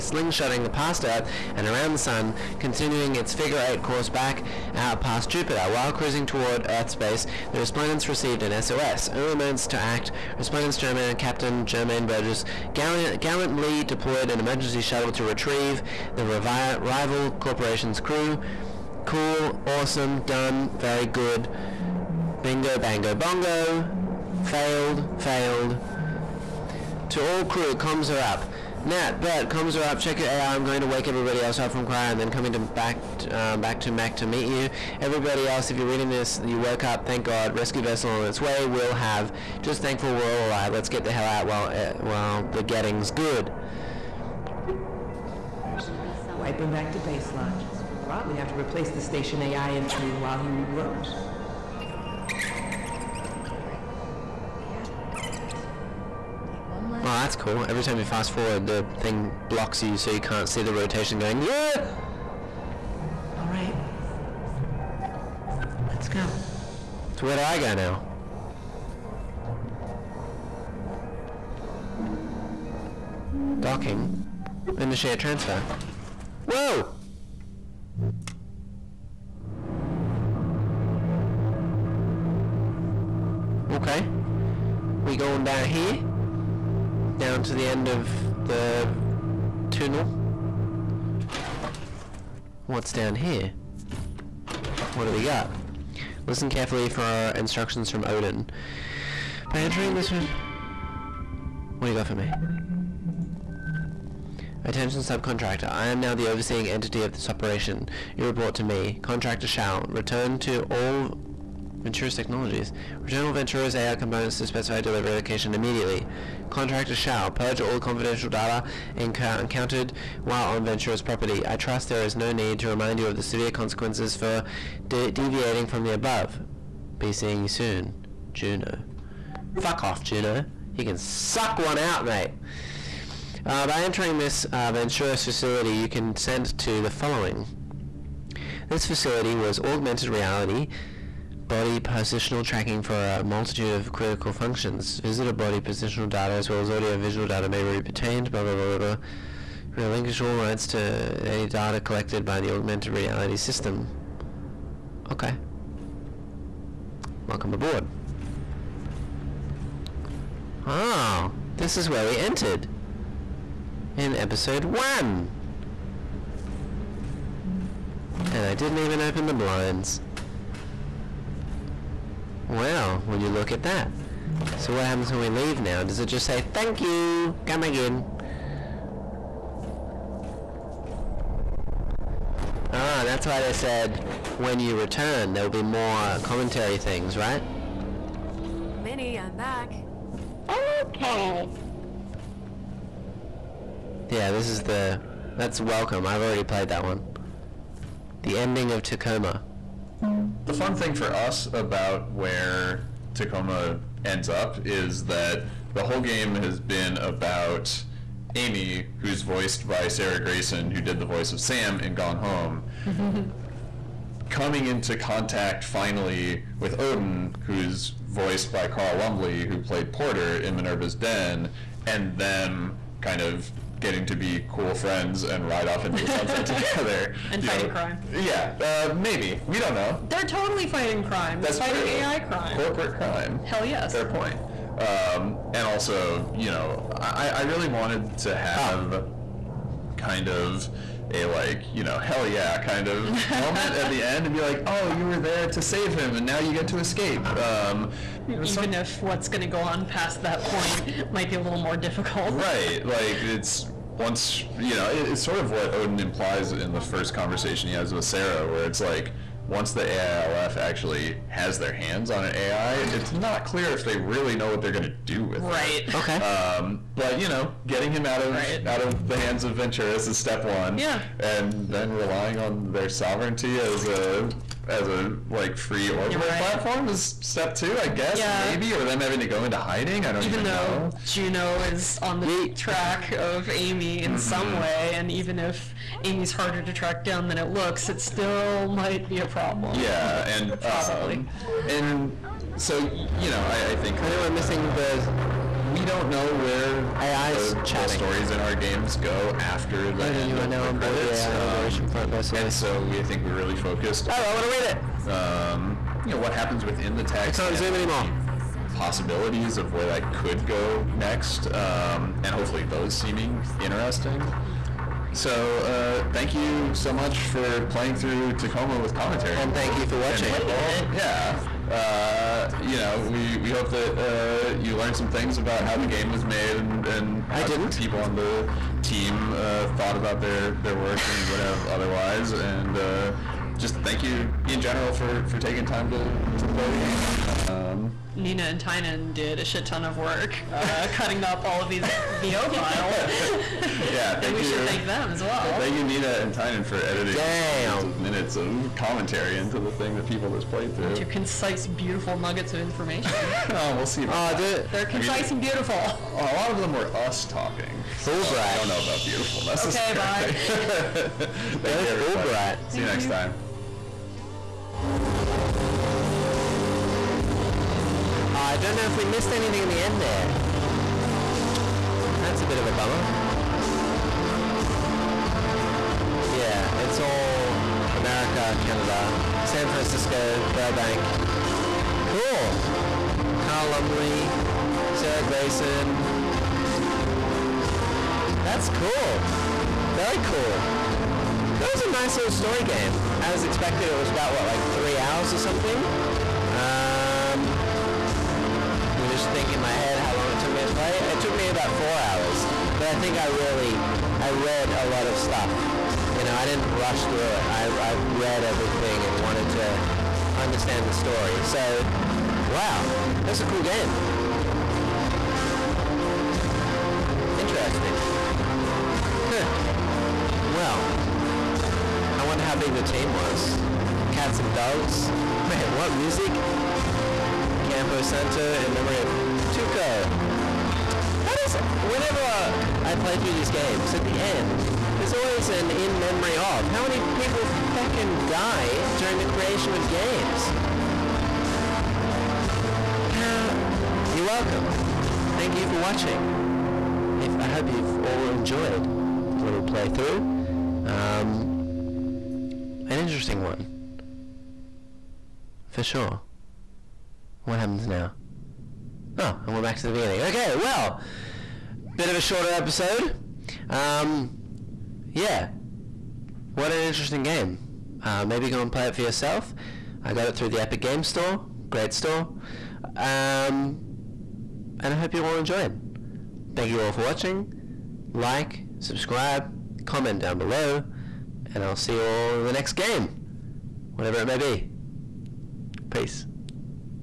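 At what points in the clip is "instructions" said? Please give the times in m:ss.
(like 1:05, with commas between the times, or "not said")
1:37.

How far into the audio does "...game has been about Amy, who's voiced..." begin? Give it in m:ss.
3:26.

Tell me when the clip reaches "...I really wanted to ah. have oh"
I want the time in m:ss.
3:57.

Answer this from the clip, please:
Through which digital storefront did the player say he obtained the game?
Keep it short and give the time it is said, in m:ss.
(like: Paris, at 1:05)
Epic Game Store, at 7:50.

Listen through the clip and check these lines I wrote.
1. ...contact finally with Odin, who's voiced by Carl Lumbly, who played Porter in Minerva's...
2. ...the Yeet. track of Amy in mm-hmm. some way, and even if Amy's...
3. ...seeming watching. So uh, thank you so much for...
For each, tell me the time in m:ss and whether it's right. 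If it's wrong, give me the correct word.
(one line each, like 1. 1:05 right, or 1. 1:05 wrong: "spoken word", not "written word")
1. 3:34 right
2. 4:42 right
3. 5:12 wrong: "interesting", not "watching".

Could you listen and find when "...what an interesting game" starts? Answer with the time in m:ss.
7:46.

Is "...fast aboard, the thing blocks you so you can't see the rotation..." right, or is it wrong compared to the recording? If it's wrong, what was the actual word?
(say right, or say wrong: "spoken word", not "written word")
wrong: "forward", not "aboard".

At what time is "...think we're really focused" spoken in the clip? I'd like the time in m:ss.
5:03.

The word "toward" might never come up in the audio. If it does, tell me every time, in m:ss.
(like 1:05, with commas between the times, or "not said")
0:06.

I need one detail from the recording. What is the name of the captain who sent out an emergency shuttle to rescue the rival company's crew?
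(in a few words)
Germaine Burgess.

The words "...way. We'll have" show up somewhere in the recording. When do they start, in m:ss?
0:38.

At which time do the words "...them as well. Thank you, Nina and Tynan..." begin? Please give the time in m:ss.
5:44.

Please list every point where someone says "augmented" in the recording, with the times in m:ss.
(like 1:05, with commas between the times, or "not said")
2:19, 2:32.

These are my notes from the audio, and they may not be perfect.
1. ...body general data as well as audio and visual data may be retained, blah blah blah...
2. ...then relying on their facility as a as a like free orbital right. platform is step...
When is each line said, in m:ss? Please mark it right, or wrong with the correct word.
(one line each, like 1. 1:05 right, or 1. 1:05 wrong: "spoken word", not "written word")
1. 2:25 wrong: "positional", not "general"
2. 4:31 wrong: "sovereignty", not "facility".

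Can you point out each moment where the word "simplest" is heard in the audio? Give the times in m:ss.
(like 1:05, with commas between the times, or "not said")
not said.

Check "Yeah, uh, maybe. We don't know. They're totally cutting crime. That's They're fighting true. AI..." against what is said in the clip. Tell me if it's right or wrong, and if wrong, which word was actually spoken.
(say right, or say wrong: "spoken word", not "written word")
wrong: "fighting", not "cutting".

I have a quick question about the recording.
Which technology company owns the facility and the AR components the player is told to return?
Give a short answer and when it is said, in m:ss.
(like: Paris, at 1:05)
Venturis Technologies, at 1:51.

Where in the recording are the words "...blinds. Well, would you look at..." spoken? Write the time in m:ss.
2:49.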